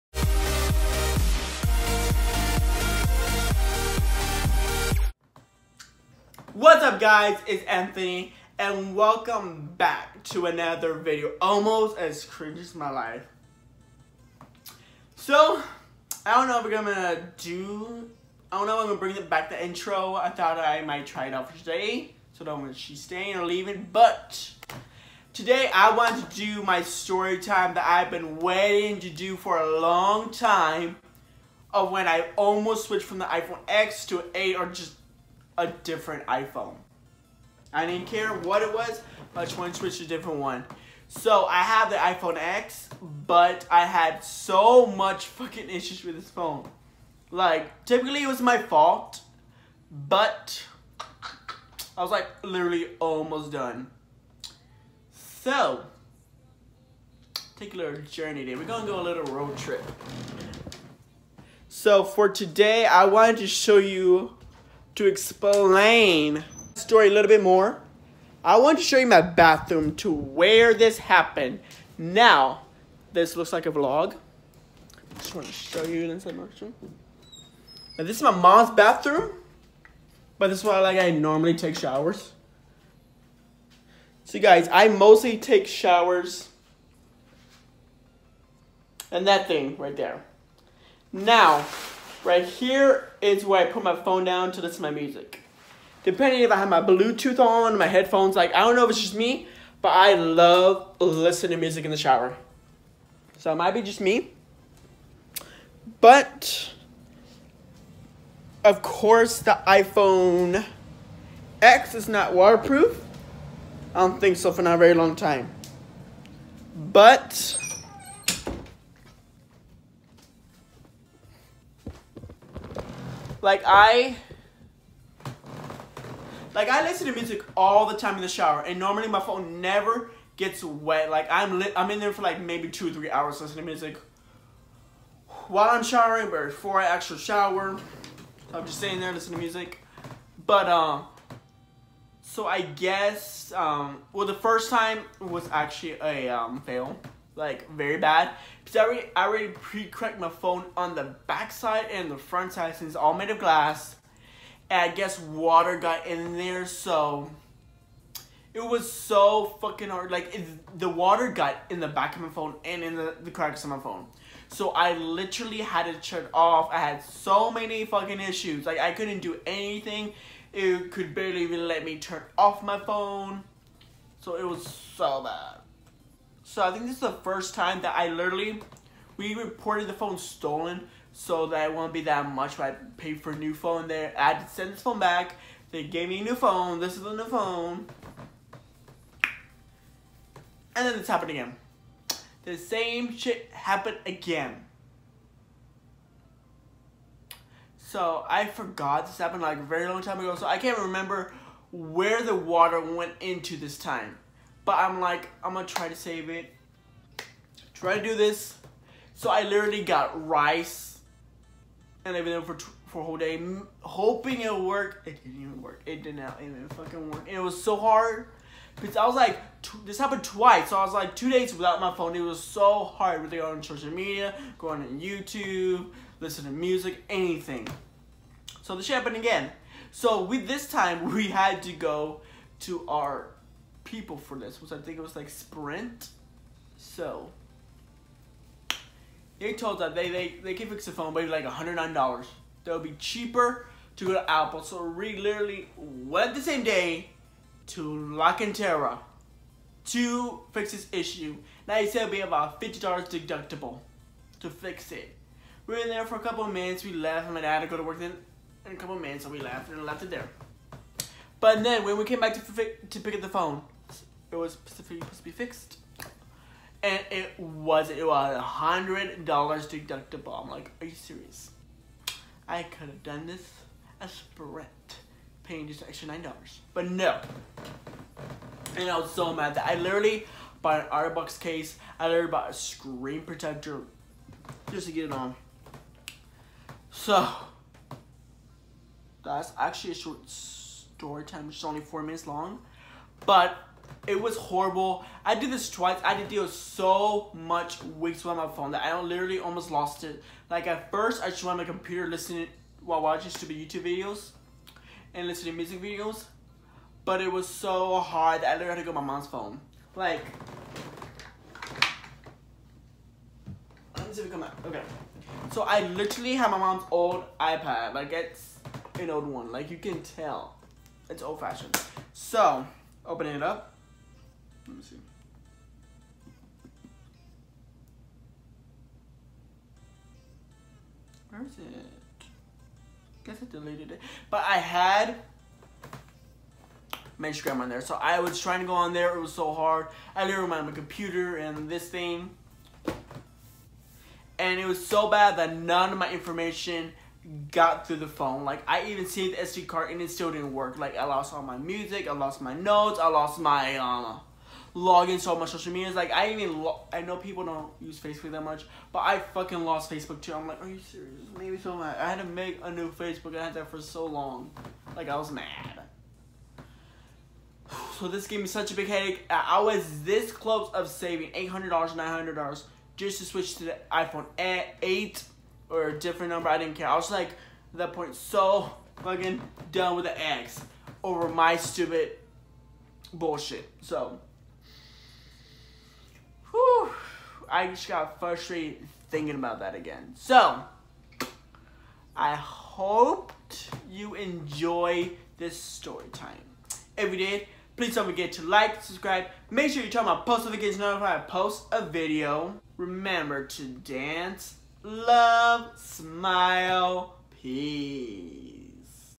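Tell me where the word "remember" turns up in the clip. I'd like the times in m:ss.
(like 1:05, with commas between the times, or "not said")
3:20, 6:42.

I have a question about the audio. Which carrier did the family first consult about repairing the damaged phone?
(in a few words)
Sprint.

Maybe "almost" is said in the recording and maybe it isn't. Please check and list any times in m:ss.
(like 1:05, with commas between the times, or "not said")
0:11, 0:32, 0:52, 4:59.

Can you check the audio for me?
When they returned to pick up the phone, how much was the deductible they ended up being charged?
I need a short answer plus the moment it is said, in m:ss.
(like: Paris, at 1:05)
$100, at 4:28.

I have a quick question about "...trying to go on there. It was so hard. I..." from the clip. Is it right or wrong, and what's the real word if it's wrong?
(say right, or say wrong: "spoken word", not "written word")
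right.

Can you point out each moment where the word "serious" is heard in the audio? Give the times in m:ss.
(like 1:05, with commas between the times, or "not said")
4:30, 6:00.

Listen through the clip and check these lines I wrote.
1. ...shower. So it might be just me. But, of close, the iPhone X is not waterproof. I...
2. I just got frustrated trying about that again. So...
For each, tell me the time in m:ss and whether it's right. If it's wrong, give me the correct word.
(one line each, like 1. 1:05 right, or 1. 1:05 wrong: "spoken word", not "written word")
1. 1:41 wrong: "course", not "close"
2. 6:27 wrong: "thinking", not "trying".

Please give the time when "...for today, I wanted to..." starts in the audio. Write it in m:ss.
1:02.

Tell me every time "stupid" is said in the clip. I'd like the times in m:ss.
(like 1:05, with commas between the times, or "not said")
5:03, 6:21.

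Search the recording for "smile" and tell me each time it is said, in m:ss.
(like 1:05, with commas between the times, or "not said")
6:45.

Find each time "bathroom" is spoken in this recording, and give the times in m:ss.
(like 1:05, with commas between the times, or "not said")
1:09, 1:18.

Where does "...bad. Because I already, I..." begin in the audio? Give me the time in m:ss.
2:27.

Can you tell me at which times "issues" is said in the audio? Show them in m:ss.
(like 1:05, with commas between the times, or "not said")
0:45, 2:48, 4:10.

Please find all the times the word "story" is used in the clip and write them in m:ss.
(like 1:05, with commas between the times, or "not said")
0:26, 1:06, 4:50, 6:35.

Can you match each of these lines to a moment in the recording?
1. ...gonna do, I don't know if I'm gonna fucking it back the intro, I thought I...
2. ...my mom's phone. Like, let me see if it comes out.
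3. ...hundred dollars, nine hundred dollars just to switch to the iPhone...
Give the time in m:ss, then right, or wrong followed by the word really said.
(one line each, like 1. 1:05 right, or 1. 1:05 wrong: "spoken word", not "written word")
1. 0:16 wrong: "bring", not "fucking"
2. 5:08 right
3. 6:11 right.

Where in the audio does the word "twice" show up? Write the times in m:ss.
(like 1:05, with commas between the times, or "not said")
3:40, 4:55.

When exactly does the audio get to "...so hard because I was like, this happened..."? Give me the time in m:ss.
3:37.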